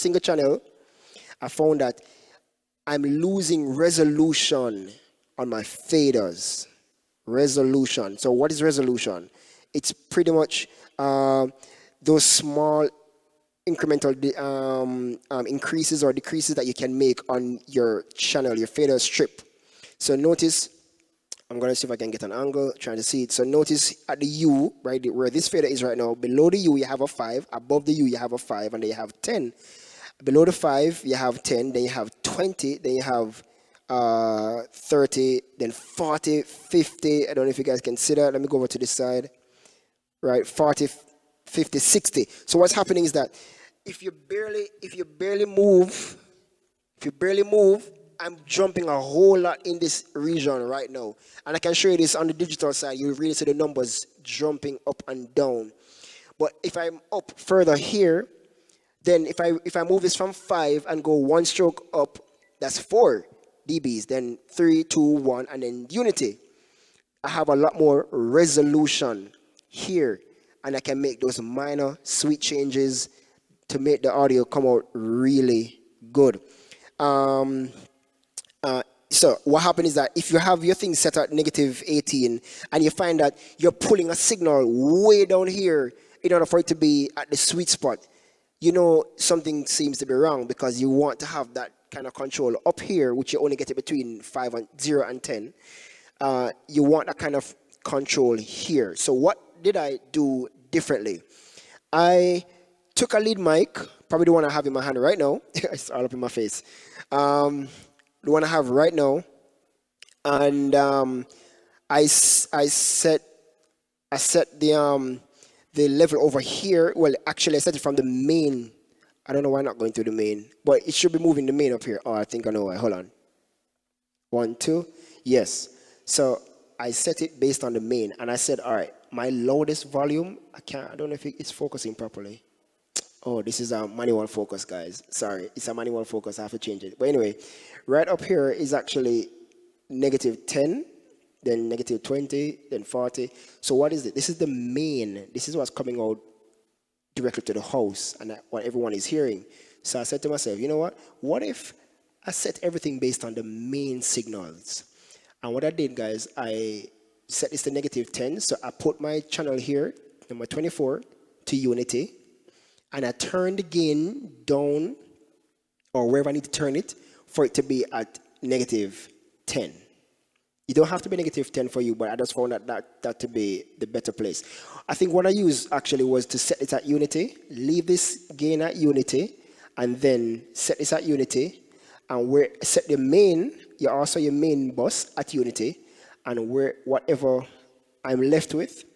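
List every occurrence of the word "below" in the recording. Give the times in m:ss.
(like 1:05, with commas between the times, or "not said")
0:26, 0:30.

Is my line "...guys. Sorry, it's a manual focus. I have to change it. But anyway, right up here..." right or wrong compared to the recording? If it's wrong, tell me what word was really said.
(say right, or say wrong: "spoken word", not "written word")
right.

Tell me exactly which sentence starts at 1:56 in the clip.
Well, actually, I set it from the main.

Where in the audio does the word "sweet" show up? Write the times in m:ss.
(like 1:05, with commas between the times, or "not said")
1:12, 1:27.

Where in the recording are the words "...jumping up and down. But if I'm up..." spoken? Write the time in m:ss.
0:54.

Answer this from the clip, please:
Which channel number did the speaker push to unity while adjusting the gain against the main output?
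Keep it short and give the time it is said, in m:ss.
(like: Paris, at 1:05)
24, at 2:40.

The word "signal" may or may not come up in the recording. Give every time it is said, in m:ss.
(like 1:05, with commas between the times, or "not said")
1:24, 2:34.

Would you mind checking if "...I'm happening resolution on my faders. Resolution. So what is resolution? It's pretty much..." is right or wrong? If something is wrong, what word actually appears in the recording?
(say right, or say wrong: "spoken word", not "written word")
wrong: "losing", not "happening".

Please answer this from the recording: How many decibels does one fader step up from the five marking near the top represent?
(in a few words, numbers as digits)
4 dB.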